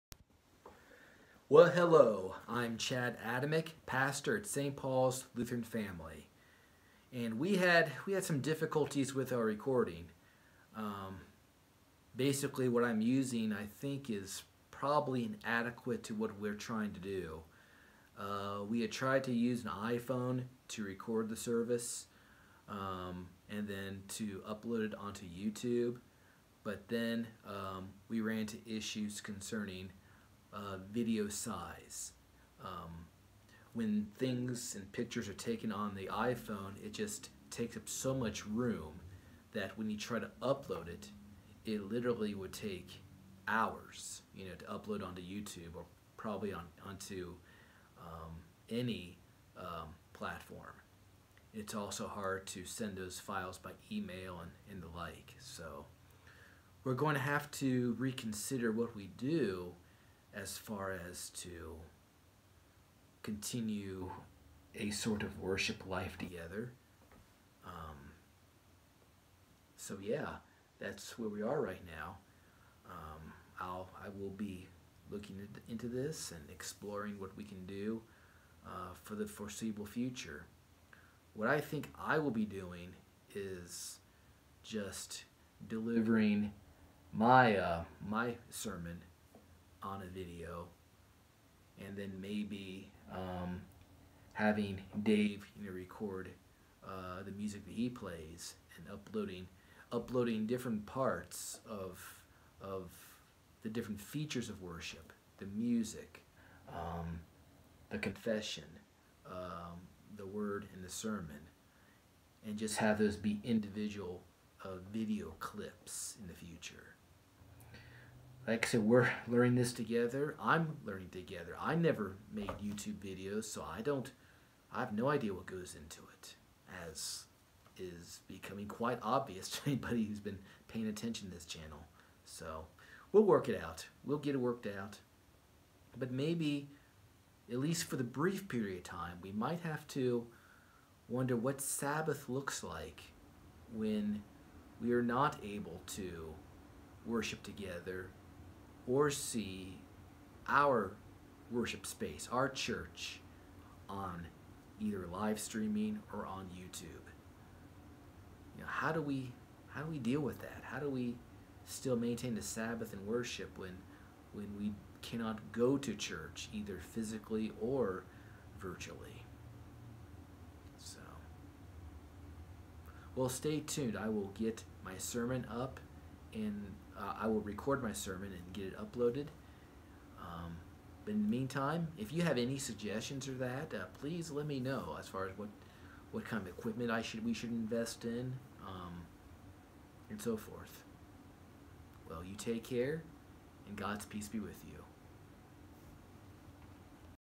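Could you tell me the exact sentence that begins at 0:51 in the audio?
It's also hard to send those files by email and, and the like.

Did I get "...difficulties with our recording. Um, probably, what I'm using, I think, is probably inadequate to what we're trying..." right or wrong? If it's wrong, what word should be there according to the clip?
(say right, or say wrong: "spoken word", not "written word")
wrong: "basically", not "probably".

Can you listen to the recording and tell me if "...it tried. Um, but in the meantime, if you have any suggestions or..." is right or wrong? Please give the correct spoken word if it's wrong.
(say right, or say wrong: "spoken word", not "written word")
wrong: "uploaded", not "tried".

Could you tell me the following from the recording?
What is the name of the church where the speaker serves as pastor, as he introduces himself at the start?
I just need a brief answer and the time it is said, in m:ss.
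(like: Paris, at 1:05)
St. Paul's Lutheran Family, at 0:04.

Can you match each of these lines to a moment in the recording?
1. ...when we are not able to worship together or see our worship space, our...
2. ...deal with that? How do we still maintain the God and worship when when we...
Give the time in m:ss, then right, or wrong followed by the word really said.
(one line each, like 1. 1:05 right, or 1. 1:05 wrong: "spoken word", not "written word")
1. 2:23 right
2. 2:39 wrong: "Sabbath", not "God".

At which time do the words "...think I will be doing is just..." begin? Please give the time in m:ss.
1:21.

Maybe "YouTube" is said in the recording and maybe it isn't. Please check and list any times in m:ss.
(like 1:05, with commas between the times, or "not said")
0:25, 0:45, 2:02, 2:36.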